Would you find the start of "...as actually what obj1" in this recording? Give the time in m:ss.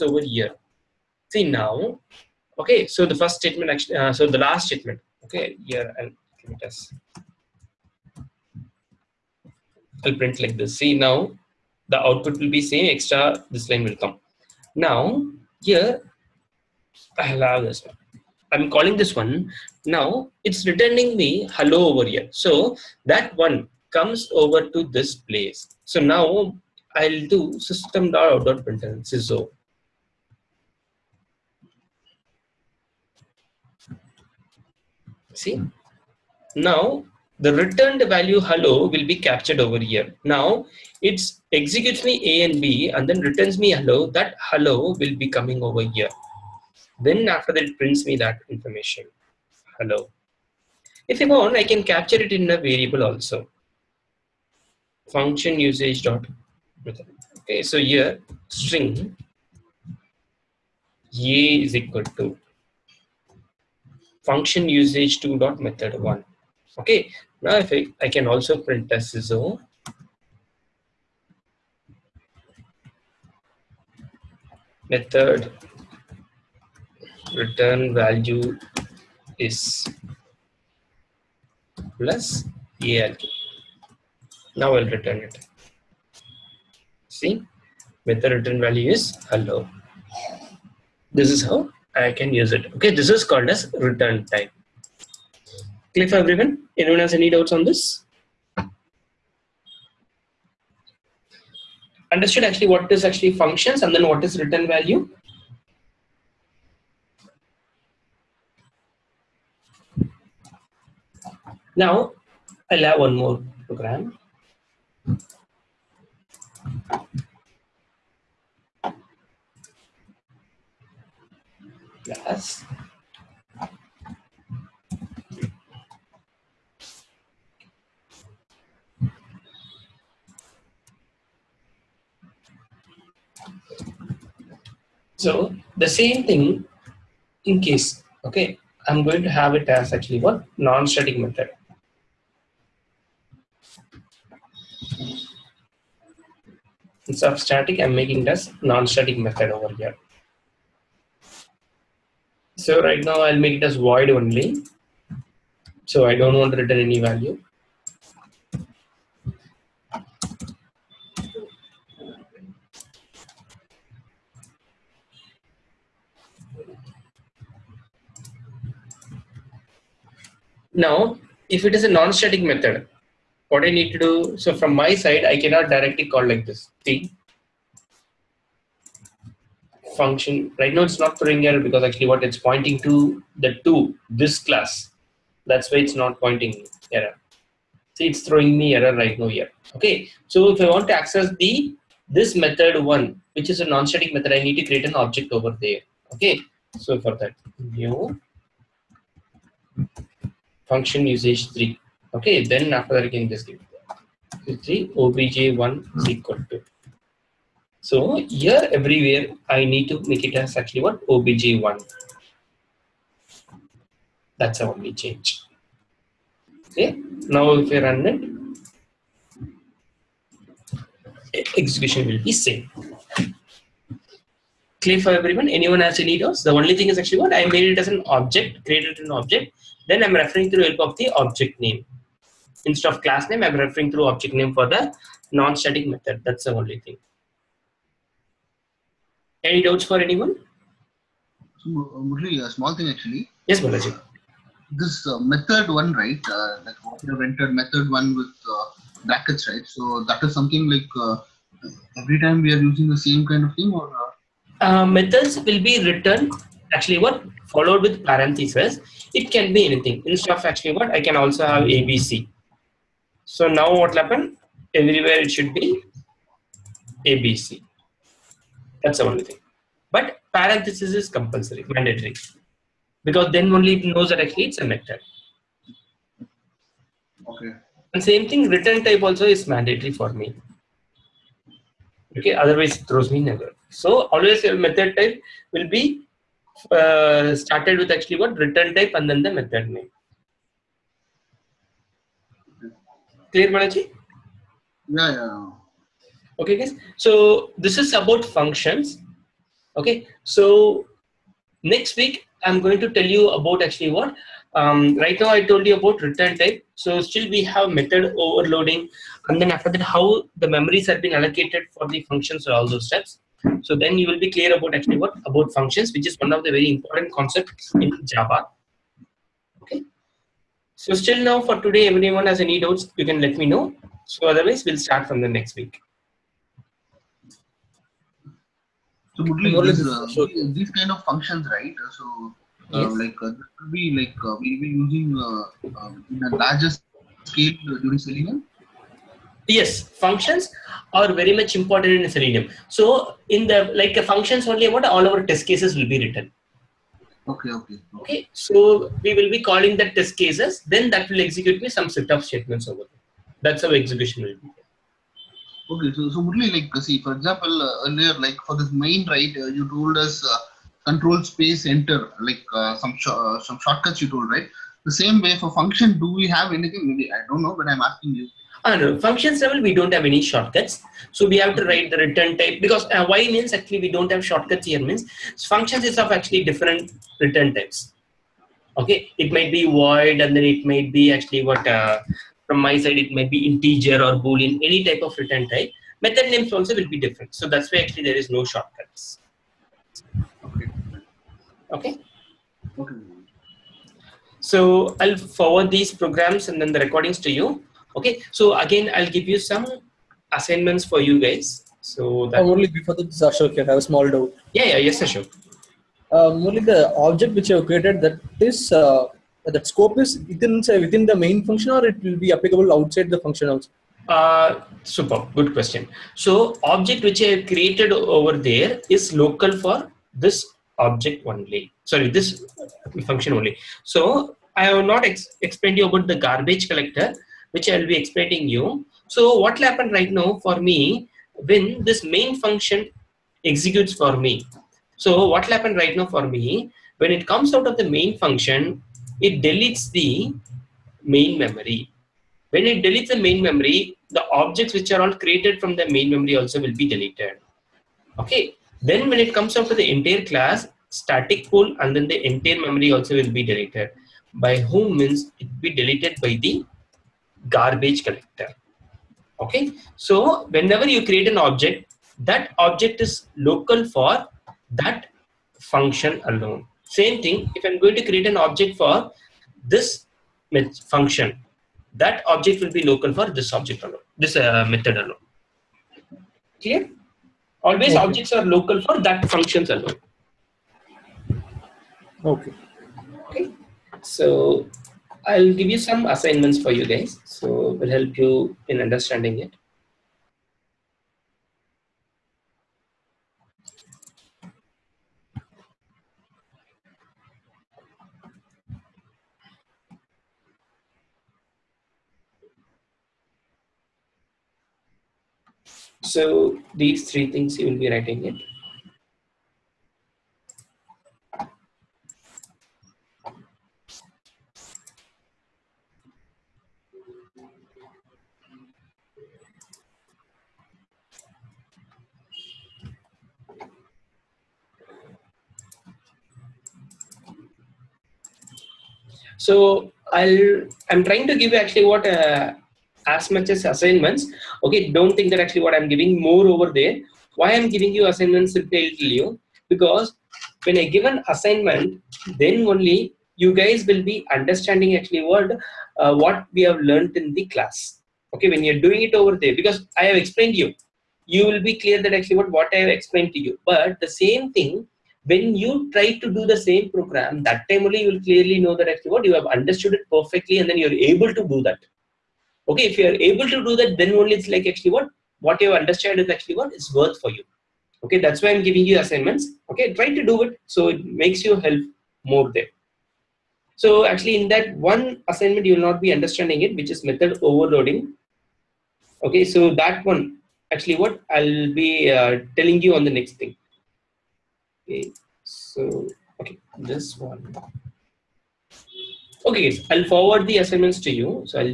3:30.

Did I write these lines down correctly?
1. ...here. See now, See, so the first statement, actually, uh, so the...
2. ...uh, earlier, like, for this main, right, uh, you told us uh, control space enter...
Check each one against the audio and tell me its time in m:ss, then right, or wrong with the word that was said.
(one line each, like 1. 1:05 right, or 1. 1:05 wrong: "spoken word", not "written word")
1. 0:00 wrong: "Okay", not "See"
2. 5:57 right.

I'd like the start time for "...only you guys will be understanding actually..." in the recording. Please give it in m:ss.
9:02.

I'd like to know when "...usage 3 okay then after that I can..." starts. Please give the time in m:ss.
3:21.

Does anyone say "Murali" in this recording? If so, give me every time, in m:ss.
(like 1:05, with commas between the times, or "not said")
4:02, 5:56.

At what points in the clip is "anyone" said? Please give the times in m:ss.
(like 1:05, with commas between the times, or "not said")
1:36, 3:45, 4:00.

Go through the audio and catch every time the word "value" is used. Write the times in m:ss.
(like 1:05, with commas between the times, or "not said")
0:38, 1:17, 1:28, 1:44, 2:36.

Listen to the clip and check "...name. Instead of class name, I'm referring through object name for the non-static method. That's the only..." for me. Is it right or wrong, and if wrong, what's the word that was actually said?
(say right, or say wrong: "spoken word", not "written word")
right.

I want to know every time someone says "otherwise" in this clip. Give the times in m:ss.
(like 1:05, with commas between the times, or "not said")
4:42, 5:24.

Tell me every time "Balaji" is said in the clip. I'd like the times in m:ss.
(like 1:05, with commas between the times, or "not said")
4:03, 4:53.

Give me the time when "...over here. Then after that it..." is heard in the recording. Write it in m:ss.
0:45.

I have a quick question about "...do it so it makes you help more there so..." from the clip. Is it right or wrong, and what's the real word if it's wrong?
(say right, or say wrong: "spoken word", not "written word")
right.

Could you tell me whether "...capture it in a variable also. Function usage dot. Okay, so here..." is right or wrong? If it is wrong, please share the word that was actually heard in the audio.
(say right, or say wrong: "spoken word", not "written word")
right.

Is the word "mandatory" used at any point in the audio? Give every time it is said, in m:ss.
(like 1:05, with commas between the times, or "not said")
4:31, 4:39.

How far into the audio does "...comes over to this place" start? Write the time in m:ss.
0:23.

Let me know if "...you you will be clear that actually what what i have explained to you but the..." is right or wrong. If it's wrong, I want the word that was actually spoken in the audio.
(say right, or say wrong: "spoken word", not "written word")
right.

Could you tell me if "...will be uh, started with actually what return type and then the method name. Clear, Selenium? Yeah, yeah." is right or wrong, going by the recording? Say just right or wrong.
wrong.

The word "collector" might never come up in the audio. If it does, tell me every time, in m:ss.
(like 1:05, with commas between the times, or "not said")
7:06, 7:38.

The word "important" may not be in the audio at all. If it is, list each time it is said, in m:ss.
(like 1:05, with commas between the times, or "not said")
5:16, 5:41.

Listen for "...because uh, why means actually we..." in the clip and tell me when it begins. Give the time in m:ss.
6:12.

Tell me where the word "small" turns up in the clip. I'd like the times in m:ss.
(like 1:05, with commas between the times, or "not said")
4:02, 6:43.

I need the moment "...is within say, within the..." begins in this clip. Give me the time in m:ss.
6:50.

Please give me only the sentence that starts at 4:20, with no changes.
Instead of actually what I can also have ABC.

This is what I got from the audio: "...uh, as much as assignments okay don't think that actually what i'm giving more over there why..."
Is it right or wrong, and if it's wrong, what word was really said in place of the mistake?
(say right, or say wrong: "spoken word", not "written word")
right.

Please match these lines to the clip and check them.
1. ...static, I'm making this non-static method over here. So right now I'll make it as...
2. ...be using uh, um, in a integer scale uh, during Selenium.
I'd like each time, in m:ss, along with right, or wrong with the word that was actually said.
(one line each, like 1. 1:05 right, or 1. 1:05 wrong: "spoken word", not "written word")
1. 2:27 right
2. 5:34 wrong: "larger", not "integer".